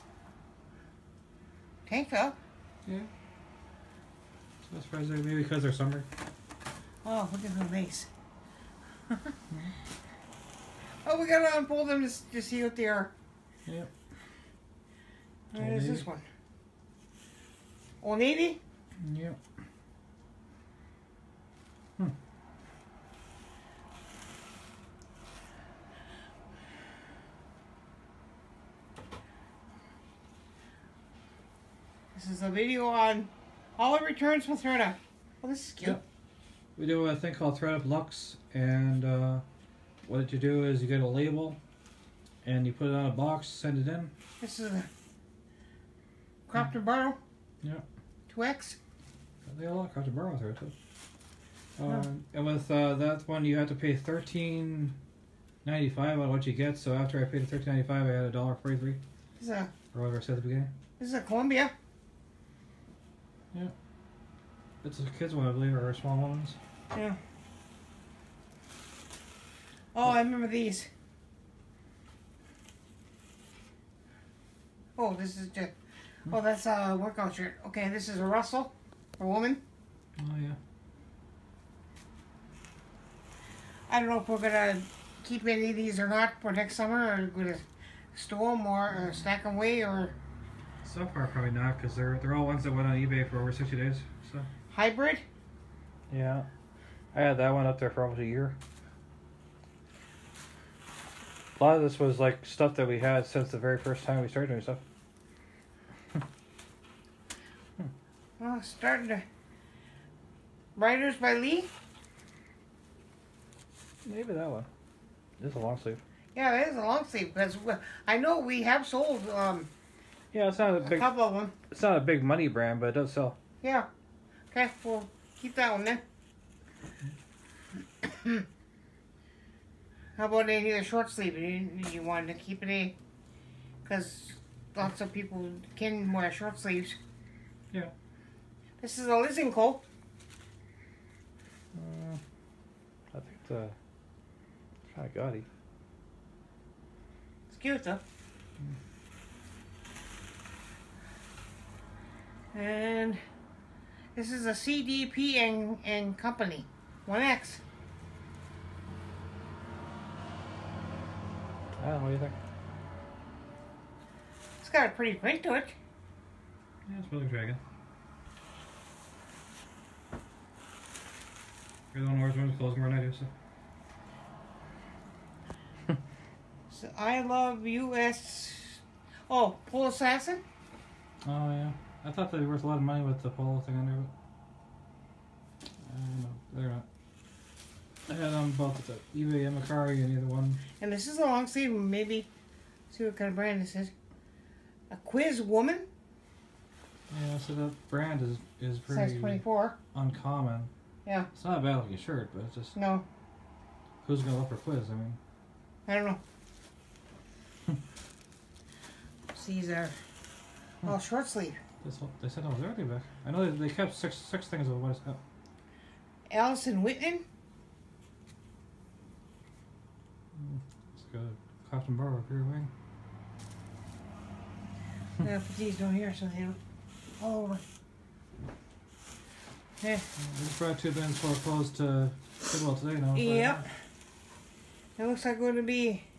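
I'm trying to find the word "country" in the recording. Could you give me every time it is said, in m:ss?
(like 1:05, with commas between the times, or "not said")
not said.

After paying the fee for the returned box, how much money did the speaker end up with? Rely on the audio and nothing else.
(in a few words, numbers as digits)
$1.43.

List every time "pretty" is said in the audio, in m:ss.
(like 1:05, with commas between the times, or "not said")
2:44, 3:18.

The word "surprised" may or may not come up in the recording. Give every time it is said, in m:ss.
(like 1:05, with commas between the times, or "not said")
0:04.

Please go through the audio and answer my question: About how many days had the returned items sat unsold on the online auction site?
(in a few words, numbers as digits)
60.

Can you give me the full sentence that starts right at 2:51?
You're the one who wears clothes more than I do, so.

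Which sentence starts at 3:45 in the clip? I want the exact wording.
Yeah, uh, but don't hear, so they don't.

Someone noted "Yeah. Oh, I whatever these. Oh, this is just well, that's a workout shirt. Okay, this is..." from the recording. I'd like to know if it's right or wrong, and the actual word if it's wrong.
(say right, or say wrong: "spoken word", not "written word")
wrong: "remember", not "whatever".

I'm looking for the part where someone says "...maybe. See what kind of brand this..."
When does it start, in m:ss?
3:11.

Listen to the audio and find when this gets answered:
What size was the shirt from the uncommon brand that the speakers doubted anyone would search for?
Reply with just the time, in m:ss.
3:19.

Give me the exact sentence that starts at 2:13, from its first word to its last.
Because lots of people can wear short sleeves.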